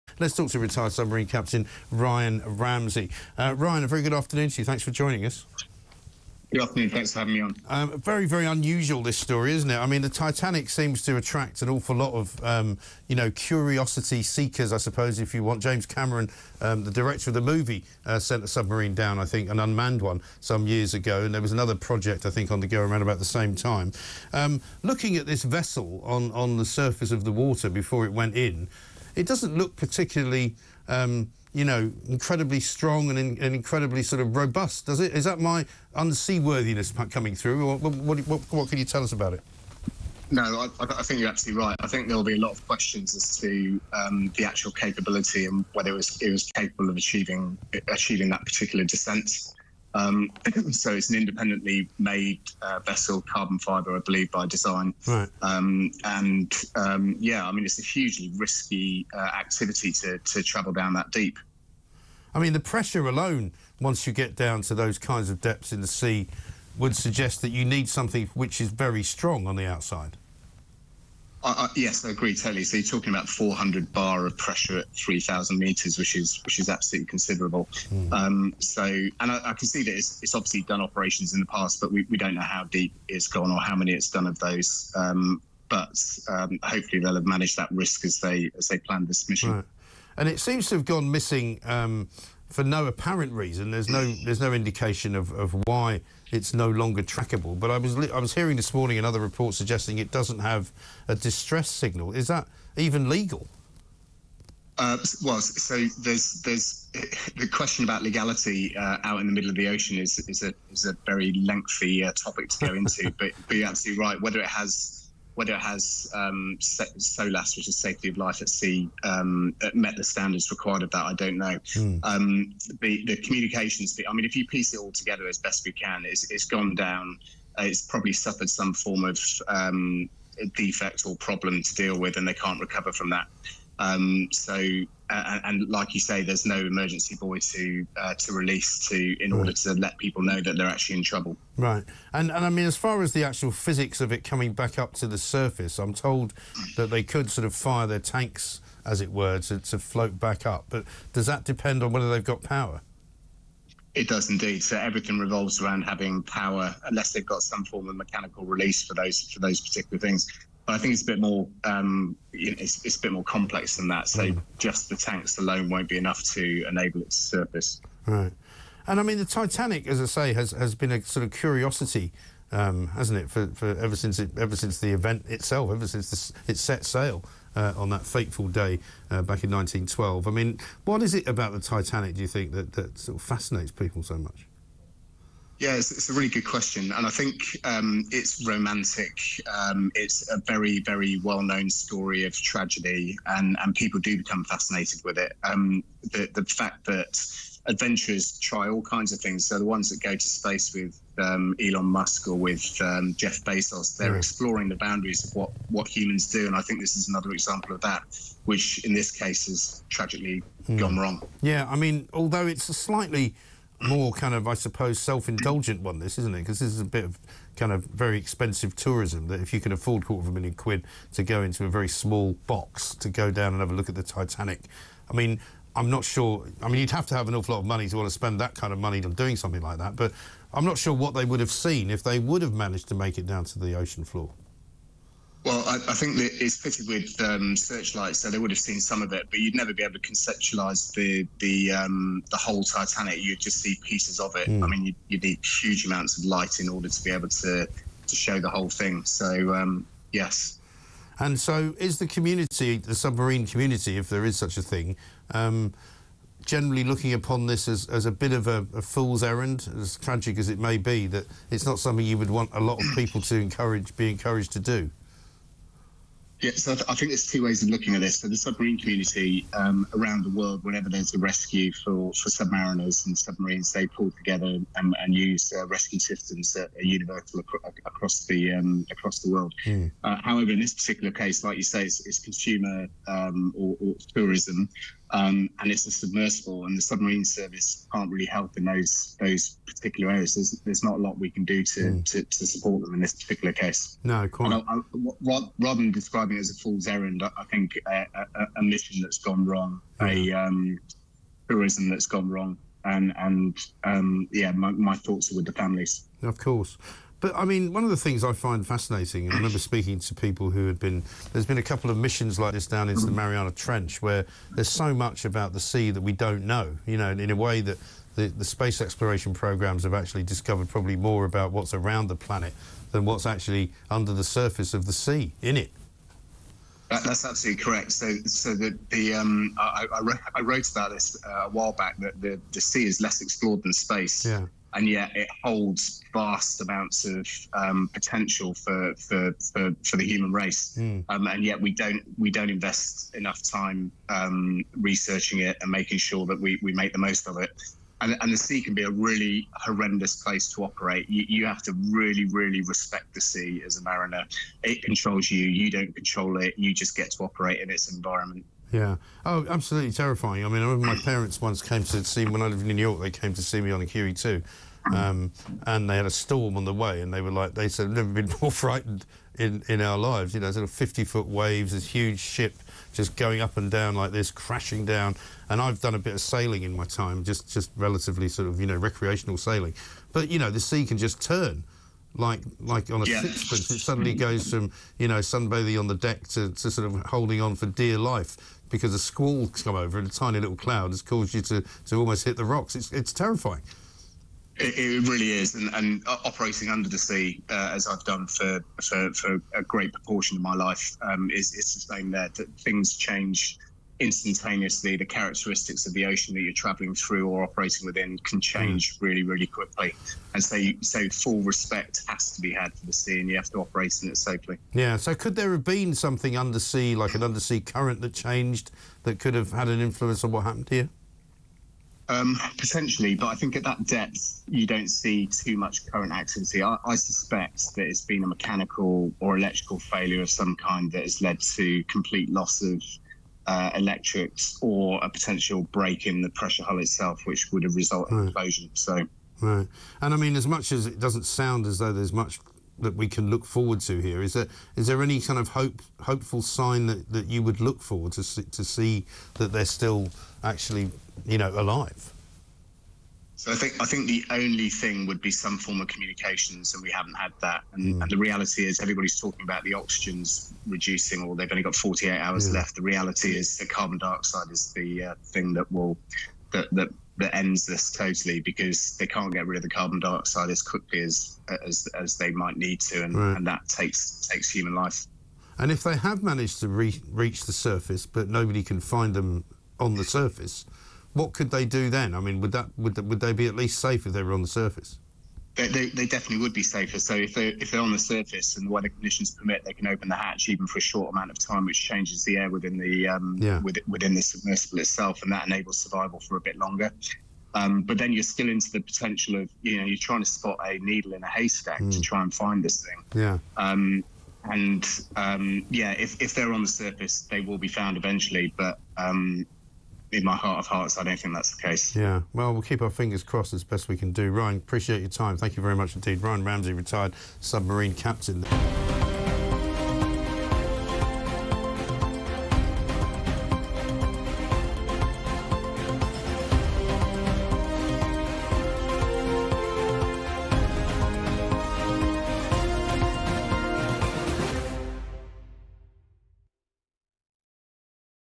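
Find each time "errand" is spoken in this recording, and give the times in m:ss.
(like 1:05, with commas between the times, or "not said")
4:19, 4:56.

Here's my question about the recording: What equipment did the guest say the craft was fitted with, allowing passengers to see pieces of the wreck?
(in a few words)
Searchlights.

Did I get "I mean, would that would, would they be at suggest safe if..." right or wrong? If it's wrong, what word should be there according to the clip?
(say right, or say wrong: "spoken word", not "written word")
wrong: "least", not "suggest".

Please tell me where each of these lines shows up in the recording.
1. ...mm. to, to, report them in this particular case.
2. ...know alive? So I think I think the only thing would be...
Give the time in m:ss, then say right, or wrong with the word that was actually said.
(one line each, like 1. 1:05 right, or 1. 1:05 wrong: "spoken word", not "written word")
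1. 4:51 wrong: "support", not "report"
2. 7:31 right.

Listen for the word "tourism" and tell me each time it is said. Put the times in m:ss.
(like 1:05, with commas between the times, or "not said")
3:38, 4:44, 5:01.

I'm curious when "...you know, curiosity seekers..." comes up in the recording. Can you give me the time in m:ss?
0:13.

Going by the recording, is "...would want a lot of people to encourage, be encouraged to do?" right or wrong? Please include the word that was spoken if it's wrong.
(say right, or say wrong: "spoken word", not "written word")
right.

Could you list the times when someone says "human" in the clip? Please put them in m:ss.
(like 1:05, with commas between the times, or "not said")
3:25, 5:40, 7:54.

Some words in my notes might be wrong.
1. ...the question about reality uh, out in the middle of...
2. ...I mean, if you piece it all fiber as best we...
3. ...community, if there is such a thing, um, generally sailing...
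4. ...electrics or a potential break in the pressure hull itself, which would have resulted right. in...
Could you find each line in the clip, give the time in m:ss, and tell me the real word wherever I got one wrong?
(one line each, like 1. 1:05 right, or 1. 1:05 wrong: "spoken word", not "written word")
1. 1:47 wrong: "legality", not "reality"
2. 2:04 wrong: "together", not "fiber"
3. 4:13 wrong: "looking", not "sailing"
4. 7:13 right.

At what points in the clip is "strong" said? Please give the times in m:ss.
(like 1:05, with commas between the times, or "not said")
0:32, 1:09.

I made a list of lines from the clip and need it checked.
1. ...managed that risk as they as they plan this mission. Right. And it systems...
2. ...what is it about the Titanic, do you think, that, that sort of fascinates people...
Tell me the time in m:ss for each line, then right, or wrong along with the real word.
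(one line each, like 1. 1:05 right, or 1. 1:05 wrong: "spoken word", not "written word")
1. 1:27 wrong: "seems", not "systems"
2. 3:00 right.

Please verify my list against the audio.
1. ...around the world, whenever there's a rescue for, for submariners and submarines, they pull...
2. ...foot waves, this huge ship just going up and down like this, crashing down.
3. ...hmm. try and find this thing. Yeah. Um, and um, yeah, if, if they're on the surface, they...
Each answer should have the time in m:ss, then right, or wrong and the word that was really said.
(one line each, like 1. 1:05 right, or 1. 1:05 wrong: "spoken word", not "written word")
1. 4:29 right
2. 6:11 right
3. 8:21 right.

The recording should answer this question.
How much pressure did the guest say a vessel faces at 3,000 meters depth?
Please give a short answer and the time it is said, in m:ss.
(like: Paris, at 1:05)
400 bar, at 1:13.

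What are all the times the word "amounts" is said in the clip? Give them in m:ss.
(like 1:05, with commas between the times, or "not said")
4:05, 5:36, 8:11.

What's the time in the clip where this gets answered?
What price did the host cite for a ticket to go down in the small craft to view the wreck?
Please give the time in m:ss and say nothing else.
3:40.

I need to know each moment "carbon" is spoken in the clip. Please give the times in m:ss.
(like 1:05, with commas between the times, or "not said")
0:53, 7:43, 7:49.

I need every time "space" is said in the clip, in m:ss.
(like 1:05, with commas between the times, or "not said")
3:20, 5:18, 5:33.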